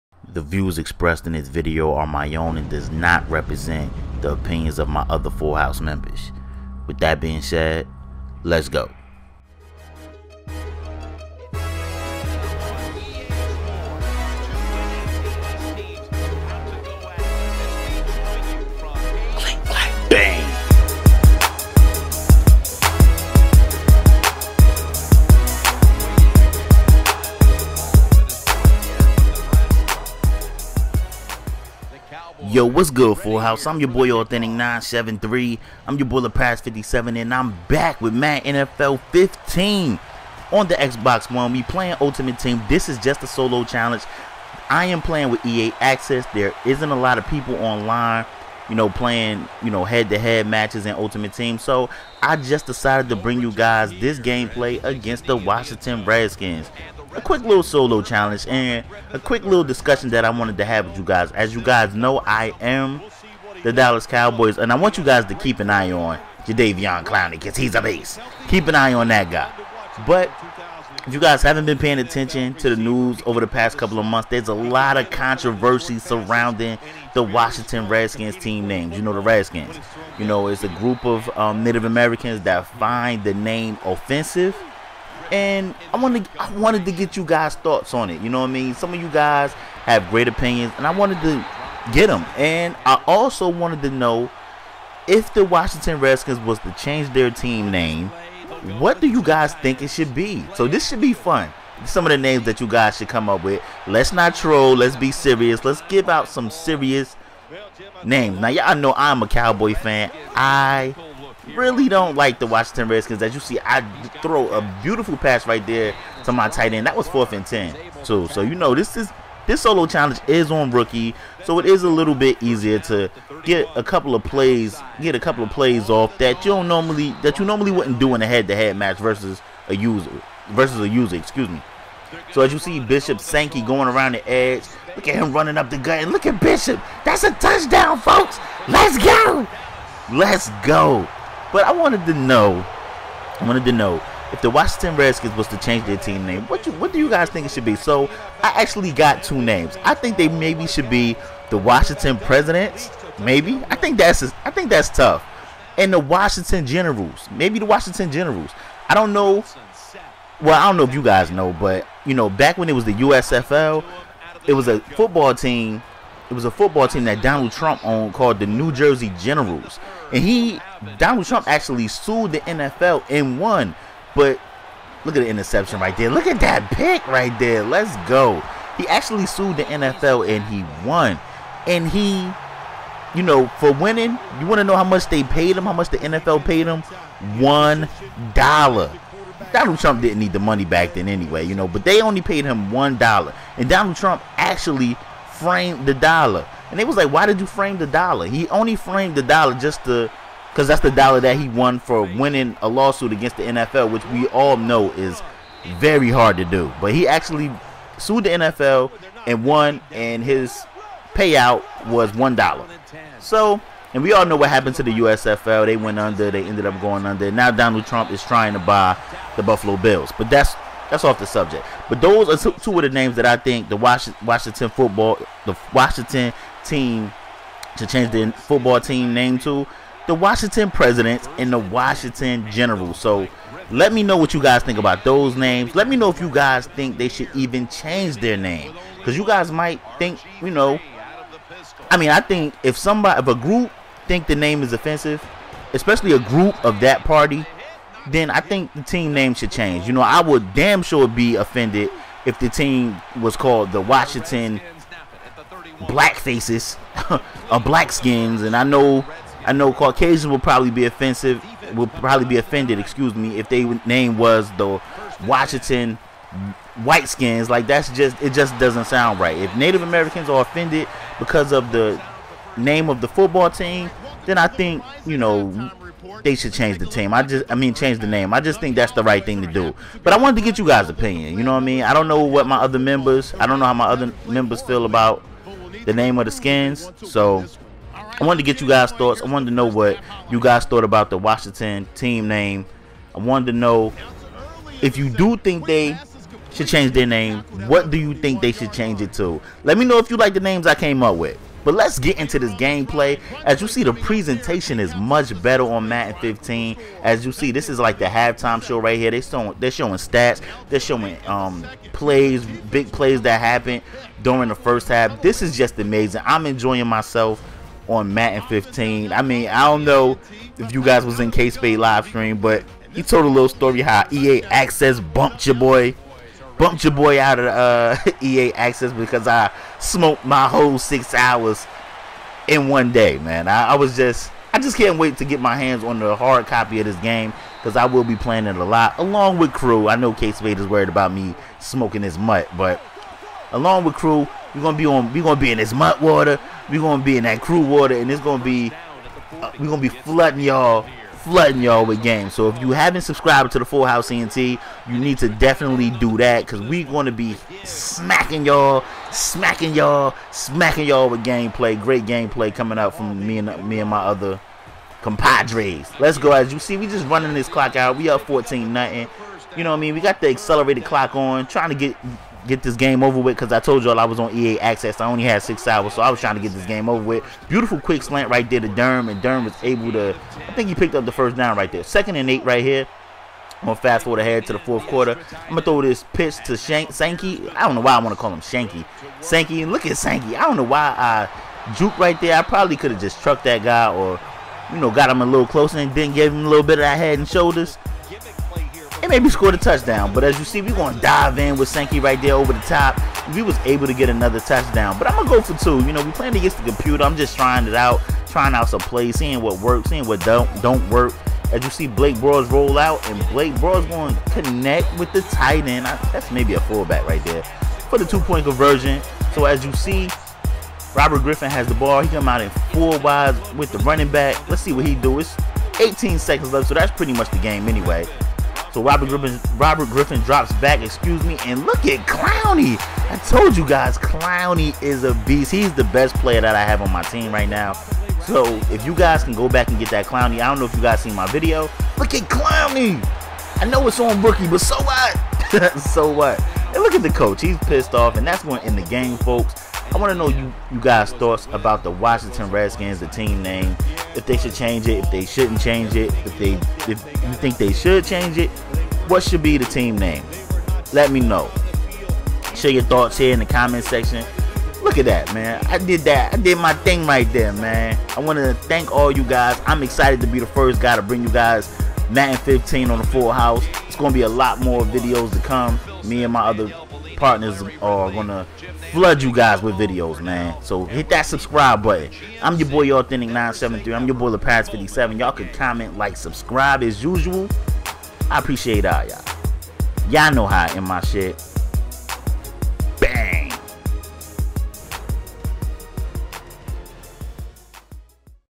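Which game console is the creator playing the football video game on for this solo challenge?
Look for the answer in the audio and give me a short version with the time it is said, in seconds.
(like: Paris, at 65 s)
Xbox One, at 40 s.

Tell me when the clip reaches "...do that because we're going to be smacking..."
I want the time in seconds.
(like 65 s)
355 s.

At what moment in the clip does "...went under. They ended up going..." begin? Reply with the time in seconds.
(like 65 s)
215 s.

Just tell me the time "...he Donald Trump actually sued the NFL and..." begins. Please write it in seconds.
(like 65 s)
170 s.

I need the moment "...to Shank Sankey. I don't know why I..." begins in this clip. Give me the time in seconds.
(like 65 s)
386 s.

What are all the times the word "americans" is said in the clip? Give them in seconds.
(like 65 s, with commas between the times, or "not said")
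81 s, 269 s.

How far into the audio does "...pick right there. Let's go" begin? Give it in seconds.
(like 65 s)
176 s.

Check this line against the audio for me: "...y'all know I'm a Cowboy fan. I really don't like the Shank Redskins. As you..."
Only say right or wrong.
wrong.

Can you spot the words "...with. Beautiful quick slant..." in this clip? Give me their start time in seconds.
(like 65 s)
377 s.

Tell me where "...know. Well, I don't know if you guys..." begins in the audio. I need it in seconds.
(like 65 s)
159 s.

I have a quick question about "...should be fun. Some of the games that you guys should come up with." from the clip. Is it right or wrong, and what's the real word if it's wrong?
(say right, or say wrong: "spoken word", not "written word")
wrong: "names", not "games".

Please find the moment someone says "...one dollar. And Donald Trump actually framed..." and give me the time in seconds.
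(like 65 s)
192 s.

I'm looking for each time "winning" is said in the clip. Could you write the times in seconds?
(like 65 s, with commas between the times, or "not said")
183 s, 202 s.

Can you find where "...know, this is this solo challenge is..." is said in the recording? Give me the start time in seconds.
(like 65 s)
118 s.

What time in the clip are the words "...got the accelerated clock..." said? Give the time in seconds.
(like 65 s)
370 s.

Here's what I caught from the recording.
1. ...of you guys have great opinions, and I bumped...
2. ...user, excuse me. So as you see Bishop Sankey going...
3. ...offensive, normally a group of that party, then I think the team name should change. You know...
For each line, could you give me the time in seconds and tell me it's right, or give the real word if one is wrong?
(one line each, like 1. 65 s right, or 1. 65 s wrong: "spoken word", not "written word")
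1. 88 s wrong: "wanted", not "bumped"
2. 130 s right
3. 244 s wrong: "especially", not "normally".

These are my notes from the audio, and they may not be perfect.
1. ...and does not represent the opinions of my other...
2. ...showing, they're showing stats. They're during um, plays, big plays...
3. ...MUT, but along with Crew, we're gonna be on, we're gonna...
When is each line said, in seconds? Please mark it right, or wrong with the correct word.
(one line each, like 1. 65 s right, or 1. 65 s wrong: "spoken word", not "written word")
1. 2 s right
2. 309 s wrong: "showing", not "during"
3. 342 s right.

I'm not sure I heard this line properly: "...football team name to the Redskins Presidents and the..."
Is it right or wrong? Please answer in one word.
wrong.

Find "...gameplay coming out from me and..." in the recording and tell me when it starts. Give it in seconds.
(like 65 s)
362 s.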